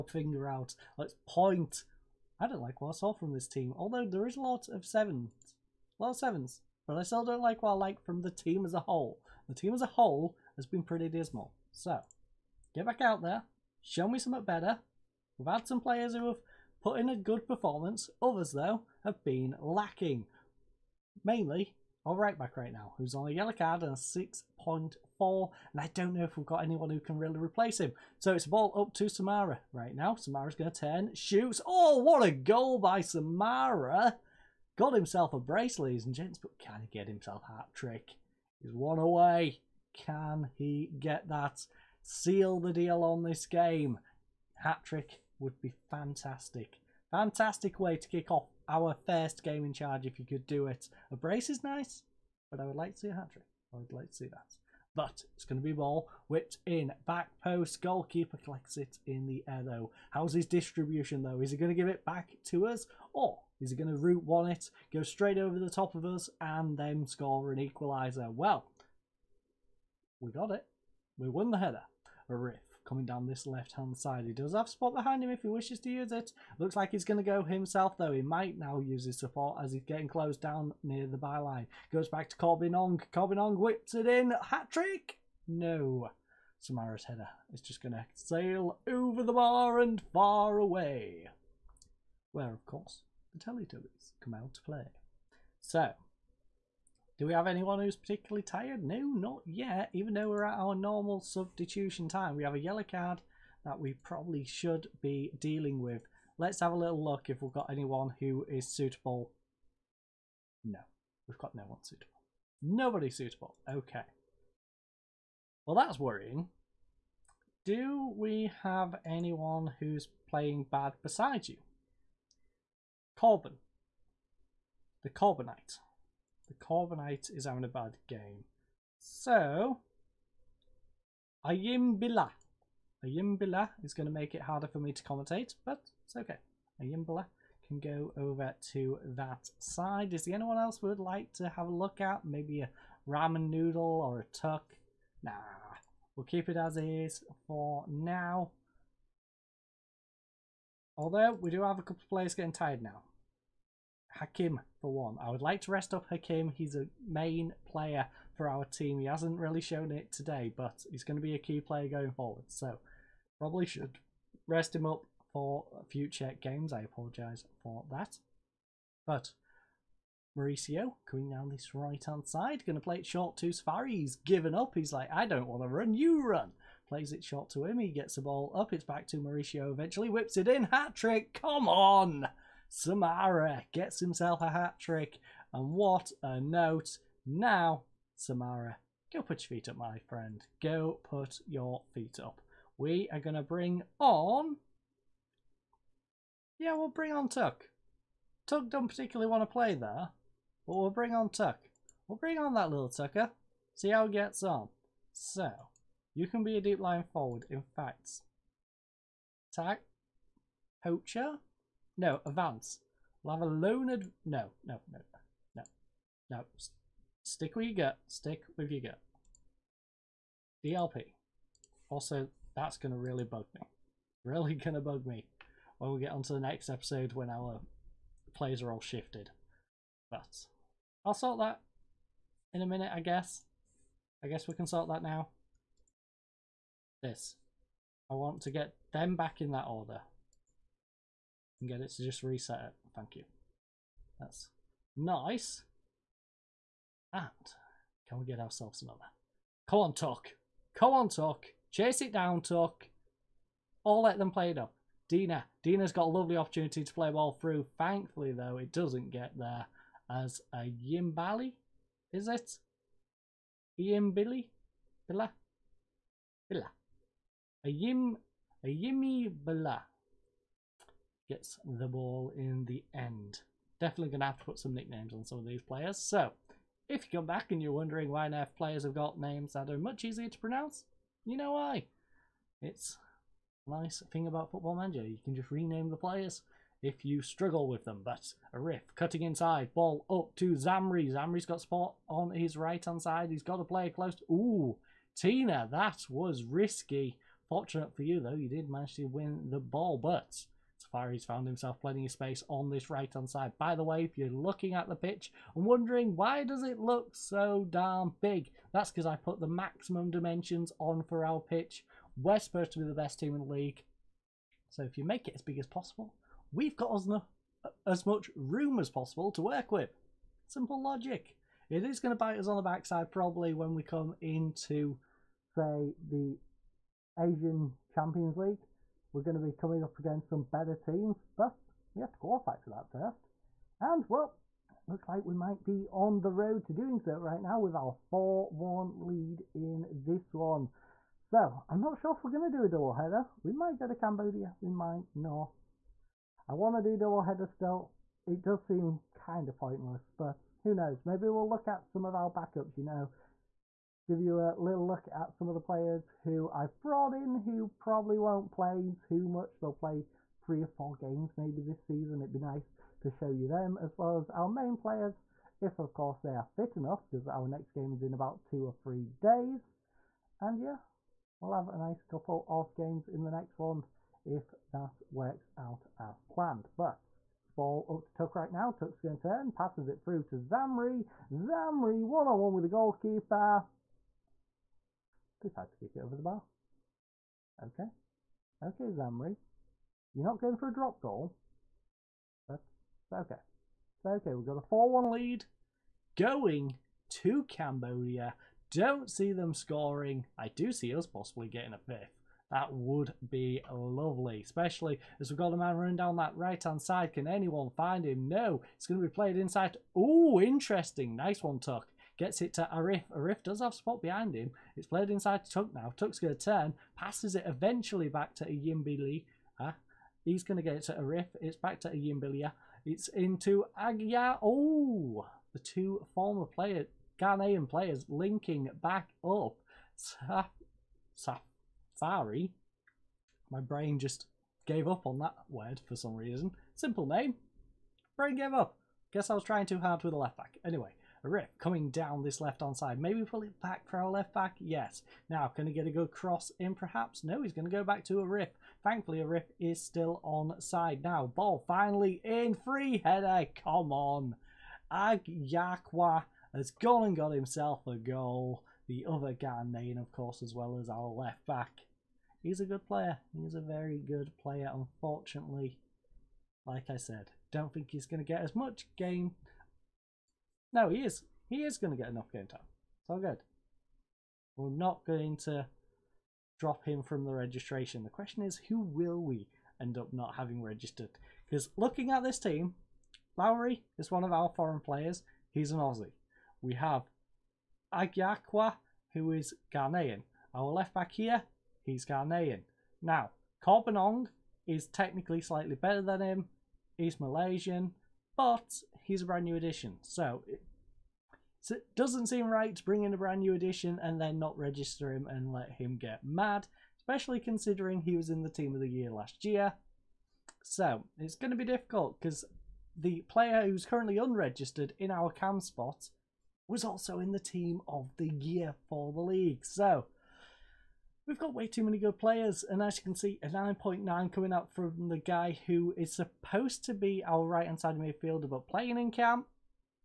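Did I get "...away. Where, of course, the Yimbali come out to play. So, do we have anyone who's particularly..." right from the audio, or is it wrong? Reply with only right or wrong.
wrong.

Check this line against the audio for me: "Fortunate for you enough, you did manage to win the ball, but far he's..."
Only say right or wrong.
wrong.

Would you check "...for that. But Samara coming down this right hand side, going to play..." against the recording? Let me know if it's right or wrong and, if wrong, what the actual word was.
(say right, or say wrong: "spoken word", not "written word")
wrong: "Mauricio", not "Samara".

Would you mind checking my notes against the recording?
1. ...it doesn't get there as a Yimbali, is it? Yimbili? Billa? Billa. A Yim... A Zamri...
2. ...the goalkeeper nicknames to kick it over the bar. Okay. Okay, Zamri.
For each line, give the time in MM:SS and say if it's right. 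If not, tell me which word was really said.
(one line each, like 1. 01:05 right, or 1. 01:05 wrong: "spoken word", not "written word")
1. 04:18 wrong: "Yimmy", not "Zamri"
2. 06:22 wrong: "decides", not "nicknames".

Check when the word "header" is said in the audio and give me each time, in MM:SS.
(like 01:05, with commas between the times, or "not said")
01:11, 01:27, 05:42, 05:47, 07:33.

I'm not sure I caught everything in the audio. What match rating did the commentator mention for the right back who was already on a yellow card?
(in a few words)
6.4.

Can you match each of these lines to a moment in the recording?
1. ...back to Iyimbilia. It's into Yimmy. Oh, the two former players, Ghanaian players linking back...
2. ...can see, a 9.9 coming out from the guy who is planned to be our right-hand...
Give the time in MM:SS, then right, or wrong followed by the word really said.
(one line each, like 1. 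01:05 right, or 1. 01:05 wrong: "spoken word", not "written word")
1. 07:01 wrong: "Agia", not "Yimmy"
2. 08:43 wrong: "supposed", not "planned".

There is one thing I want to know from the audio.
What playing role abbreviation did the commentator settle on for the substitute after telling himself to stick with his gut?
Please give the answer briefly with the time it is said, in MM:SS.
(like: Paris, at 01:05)
DLP, at 03:40.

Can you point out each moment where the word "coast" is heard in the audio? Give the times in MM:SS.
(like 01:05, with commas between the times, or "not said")
not said.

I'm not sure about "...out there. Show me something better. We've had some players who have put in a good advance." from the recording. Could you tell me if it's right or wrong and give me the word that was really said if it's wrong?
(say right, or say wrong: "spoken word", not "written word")
wrong: "performance", not "advance".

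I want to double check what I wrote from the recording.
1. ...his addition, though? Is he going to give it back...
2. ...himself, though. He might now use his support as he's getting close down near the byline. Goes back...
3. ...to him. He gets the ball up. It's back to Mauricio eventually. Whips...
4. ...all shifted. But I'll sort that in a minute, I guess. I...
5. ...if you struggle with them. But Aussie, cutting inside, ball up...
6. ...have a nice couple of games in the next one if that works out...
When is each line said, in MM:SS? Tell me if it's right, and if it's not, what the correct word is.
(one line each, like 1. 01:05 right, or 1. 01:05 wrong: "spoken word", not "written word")
1. 01:00 wrong: "distribution", not "addition"
2. 01:17 right
3. 02:57 right
4. 03:48 right
5. 04:46 wrong: "Arif", not "Aussie"
6. 06:11 right.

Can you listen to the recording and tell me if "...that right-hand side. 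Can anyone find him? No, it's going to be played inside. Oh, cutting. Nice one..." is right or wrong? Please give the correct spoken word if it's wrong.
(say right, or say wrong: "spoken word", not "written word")
wrong: "interesting", not "cutting".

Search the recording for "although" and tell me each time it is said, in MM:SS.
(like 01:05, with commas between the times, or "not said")
00:03, 02:30.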